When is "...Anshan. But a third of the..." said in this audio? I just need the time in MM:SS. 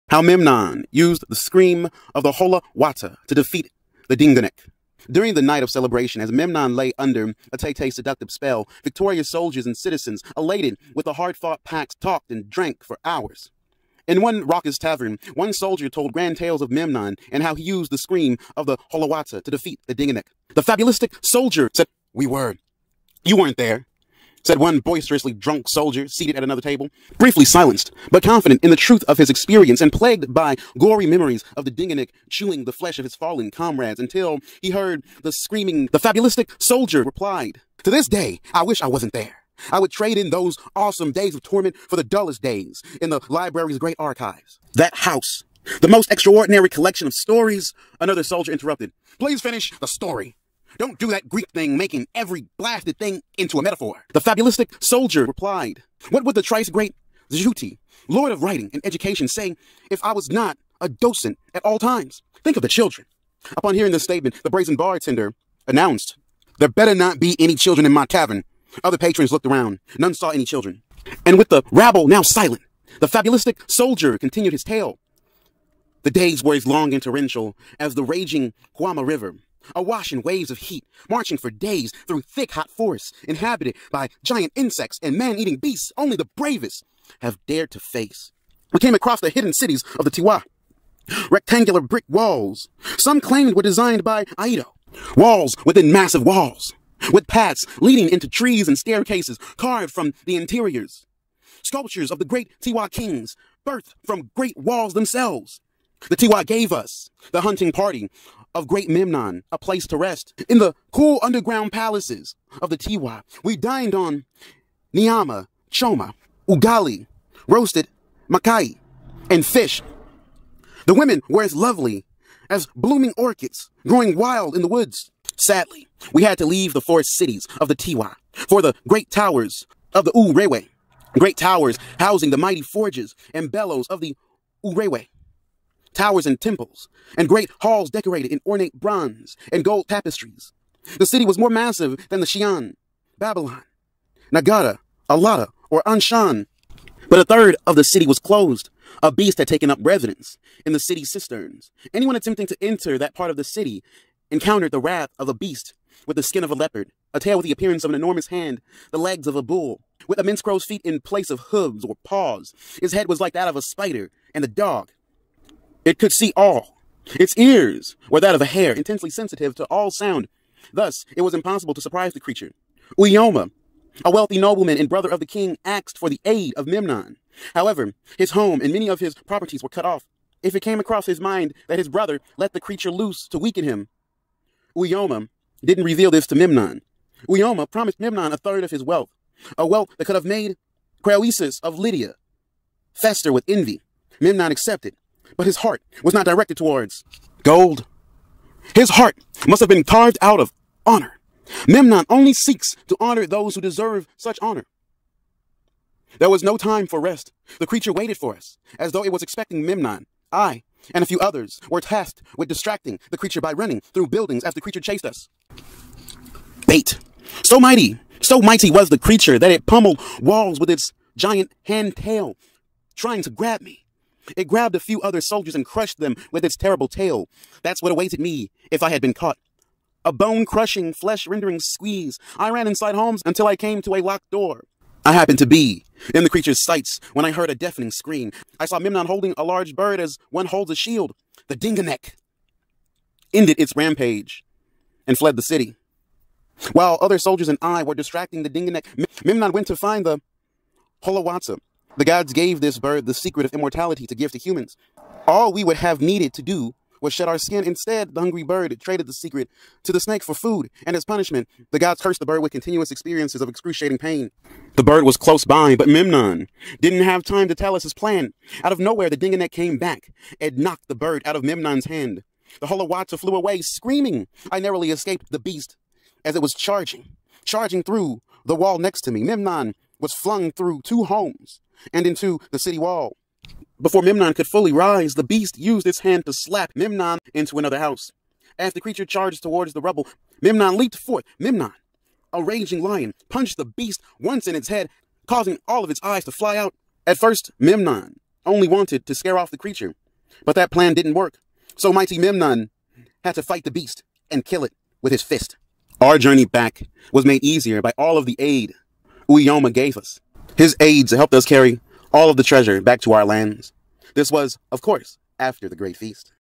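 02:25.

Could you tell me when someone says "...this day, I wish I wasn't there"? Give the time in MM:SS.
00:37.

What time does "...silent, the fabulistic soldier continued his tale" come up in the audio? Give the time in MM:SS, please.
01:12.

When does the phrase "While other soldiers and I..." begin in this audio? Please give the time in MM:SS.
04:06.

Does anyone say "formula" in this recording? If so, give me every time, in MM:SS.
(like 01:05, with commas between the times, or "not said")
not said.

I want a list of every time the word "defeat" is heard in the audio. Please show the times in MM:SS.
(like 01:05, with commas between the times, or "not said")
00:03, 00:19.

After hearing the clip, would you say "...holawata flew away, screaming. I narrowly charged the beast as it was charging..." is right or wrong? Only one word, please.
wrong.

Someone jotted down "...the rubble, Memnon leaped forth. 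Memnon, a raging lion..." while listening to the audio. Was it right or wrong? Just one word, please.
right.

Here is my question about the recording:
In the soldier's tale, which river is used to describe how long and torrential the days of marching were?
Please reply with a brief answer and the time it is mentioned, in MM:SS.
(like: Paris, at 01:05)
Guama River, at 01:18.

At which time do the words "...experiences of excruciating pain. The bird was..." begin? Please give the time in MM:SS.
04:22.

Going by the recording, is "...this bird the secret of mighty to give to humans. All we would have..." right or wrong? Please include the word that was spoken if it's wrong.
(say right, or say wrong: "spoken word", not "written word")
wrong: "immortality", not "mighty".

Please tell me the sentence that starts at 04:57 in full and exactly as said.
At first, Memnon only wanted to scare off the creature, but that plan didn't work.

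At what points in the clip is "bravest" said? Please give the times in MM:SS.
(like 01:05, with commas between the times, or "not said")
01:26.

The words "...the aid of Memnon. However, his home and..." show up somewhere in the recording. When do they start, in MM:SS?
02:56.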